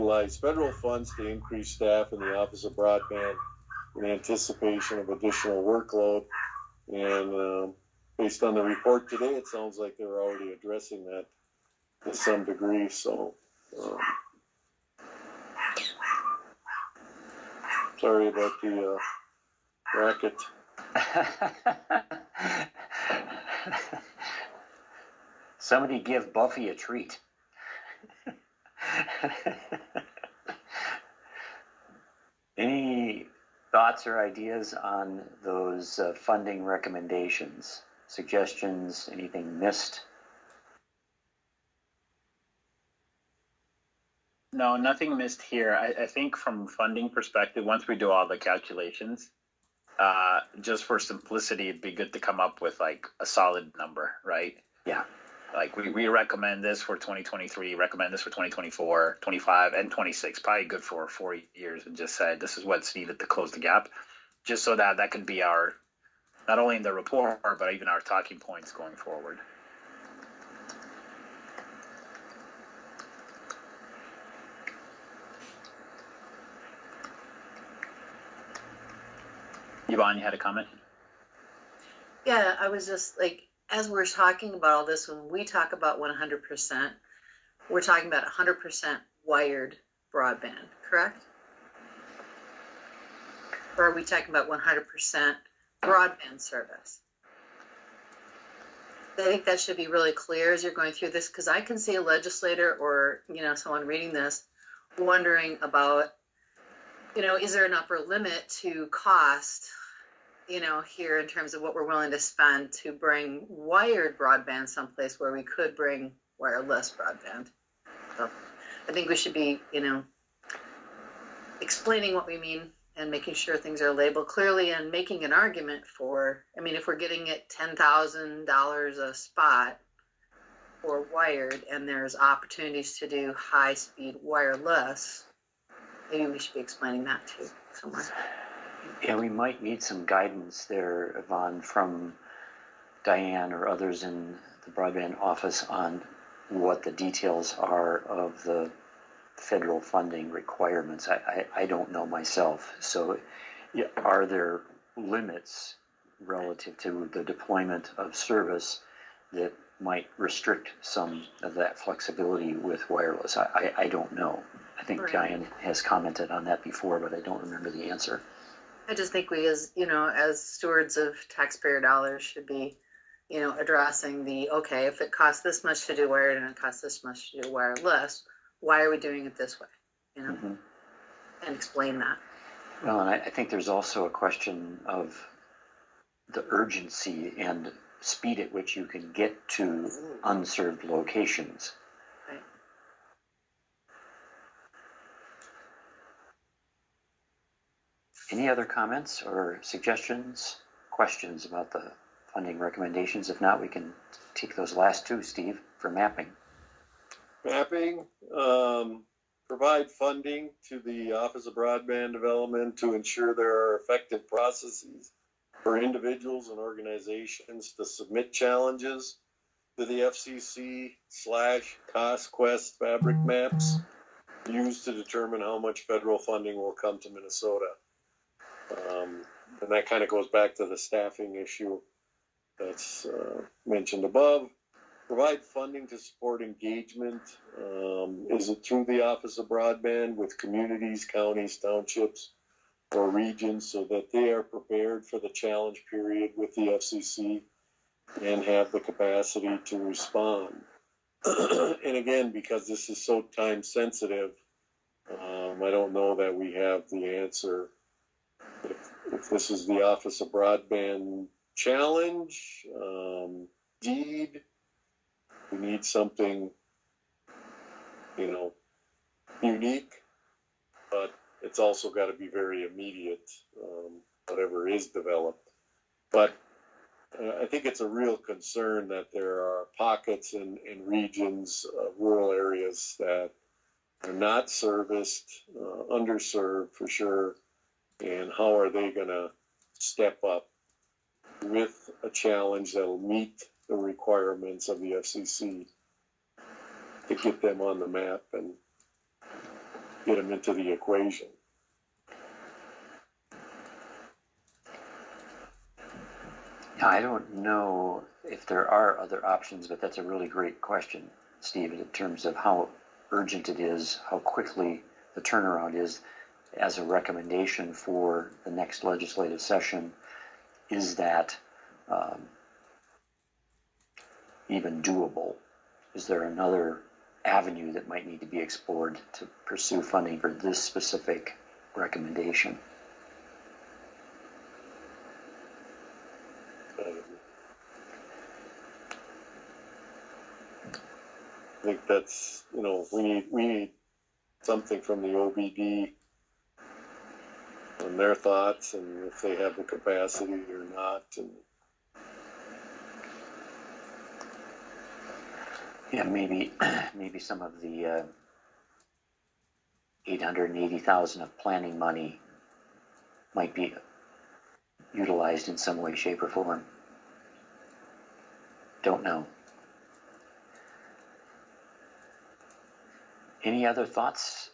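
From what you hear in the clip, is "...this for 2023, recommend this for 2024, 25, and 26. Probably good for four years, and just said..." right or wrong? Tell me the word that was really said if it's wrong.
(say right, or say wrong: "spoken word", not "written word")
right.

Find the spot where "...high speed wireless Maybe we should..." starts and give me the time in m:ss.
2:13.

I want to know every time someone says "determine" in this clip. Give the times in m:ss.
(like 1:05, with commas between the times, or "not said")
3:44.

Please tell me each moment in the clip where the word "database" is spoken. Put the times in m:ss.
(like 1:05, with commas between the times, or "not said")
not said.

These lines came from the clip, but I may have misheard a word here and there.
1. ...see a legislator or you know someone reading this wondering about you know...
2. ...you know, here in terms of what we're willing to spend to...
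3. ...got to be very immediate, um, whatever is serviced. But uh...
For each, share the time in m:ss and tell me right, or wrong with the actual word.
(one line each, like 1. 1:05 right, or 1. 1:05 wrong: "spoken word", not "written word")
1. 1:41 right
2. 1:50 right
3. 4:31 wrong: "developed", not "serviced".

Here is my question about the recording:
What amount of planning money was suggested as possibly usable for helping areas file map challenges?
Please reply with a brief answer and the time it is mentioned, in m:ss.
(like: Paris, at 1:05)
$880,000, at 6:00.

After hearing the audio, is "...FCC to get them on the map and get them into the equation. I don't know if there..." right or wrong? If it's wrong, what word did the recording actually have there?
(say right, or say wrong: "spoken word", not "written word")
right.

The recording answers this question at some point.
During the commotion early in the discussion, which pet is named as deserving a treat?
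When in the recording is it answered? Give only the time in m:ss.
0:26.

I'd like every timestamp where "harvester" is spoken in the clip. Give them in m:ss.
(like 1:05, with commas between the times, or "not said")
not said.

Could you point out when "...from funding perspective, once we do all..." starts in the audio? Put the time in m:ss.
0:46.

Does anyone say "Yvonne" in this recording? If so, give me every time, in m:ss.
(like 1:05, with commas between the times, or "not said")
1:19, 2:21.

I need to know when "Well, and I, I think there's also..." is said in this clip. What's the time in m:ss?
3:02.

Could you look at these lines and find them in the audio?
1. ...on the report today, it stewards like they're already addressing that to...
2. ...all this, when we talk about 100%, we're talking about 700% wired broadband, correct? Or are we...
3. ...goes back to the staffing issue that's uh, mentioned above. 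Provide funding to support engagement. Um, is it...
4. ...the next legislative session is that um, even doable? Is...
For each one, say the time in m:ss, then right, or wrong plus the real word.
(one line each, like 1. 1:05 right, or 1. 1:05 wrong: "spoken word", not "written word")
1. 0:08 wrong: "sounds", not "stewards"
2. 1:24 wrong: "100", not "700"
3. 3:50 right
4. 5:18 right.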